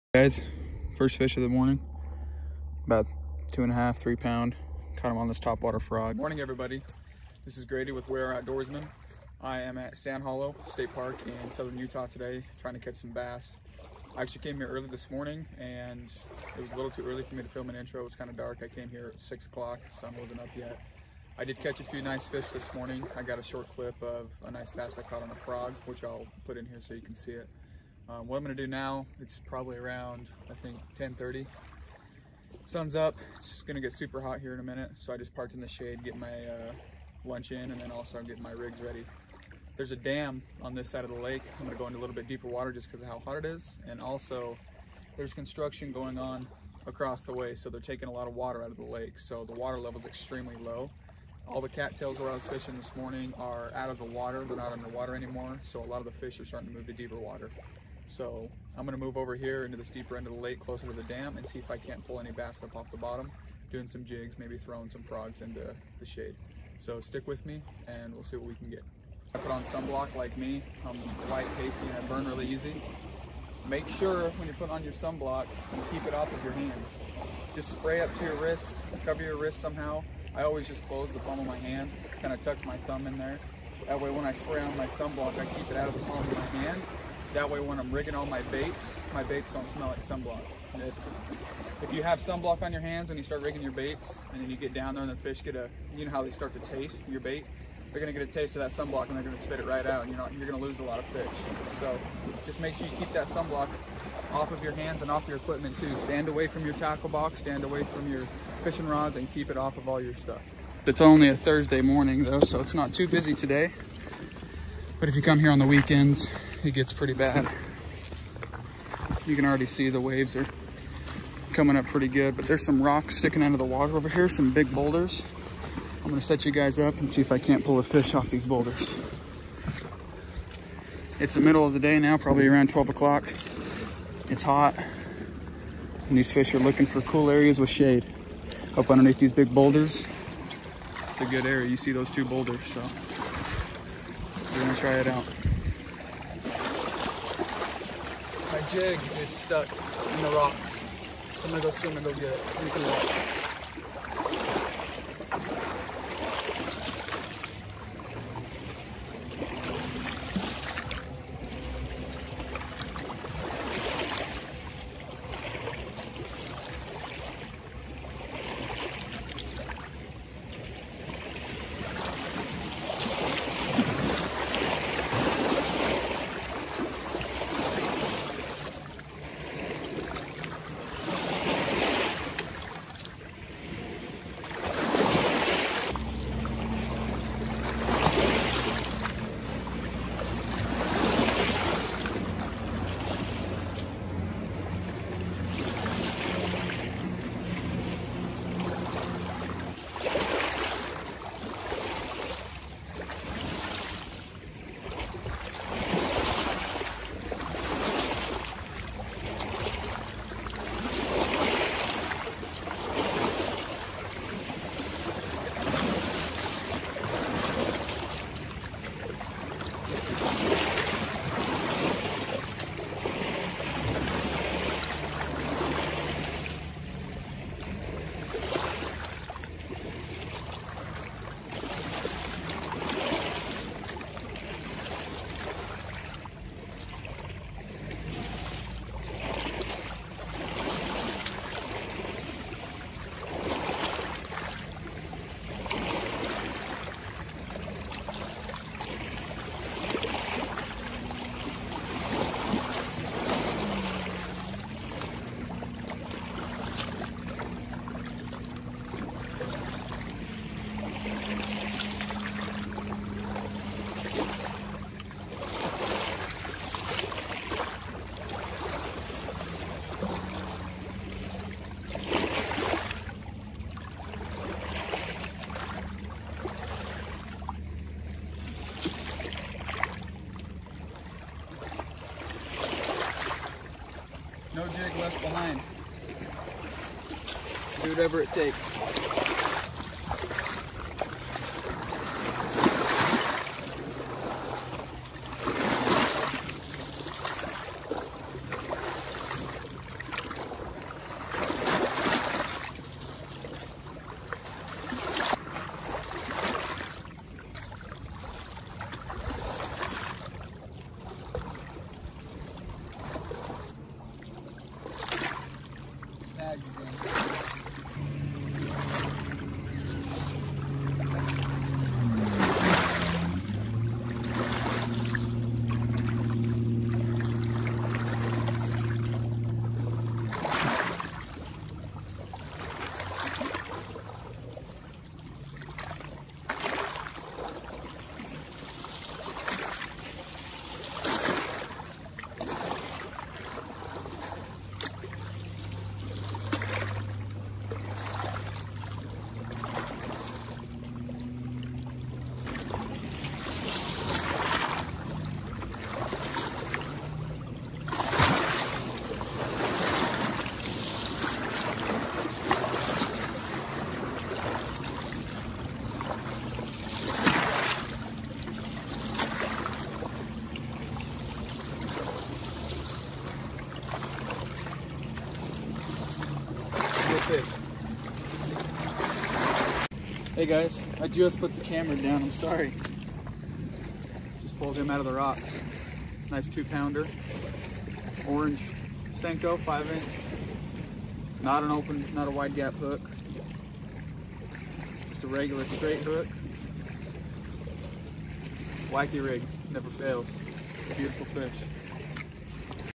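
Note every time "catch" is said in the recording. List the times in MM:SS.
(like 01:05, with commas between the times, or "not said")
00:12, 00:21.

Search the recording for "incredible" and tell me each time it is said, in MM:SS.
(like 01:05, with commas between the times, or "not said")
not said.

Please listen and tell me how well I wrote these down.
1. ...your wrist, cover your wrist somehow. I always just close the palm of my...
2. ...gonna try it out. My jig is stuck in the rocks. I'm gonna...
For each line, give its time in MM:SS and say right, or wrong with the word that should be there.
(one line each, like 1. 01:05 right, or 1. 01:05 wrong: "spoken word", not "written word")
1. 01:18 right
2. 02:24 right.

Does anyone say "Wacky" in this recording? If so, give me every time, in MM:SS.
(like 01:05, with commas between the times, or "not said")
06:38.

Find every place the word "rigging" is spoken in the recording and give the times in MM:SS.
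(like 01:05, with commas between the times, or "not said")
01:27, 01:33.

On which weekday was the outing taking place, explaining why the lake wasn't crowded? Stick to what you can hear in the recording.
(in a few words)
Thursday.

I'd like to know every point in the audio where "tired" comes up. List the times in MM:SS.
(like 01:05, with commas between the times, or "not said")
not said.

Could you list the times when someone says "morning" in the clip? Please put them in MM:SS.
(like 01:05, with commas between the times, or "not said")
00:01, 00:06, 00:15, 00:22, 00:52, 01:51.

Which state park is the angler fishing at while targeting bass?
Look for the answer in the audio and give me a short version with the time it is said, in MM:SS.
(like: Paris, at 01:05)
Sand Hollow State Park, at 00:09.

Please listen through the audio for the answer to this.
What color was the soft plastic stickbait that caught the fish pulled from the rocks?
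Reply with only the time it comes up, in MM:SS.
06:28.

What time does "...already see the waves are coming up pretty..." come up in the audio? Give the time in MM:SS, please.
01:59.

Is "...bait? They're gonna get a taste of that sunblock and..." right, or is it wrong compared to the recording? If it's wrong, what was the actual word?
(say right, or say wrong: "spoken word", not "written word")
right.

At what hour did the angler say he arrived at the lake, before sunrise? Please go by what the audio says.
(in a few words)
6 o'clock.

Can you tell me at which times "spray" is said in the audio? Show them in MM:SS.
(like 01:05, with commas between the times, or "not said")
01:17, 01:24.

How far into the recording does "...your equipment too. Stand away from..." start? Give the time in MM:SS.
01:45.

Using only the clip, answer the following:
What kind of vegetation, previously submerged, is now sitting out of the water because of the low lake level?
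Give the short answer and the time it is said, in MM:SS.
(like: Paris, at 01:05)
cattails, at 00:51.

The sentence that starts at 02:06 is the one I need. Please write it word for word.
I'm gonna set you guys up and see if I can't pull a fish off these boulders.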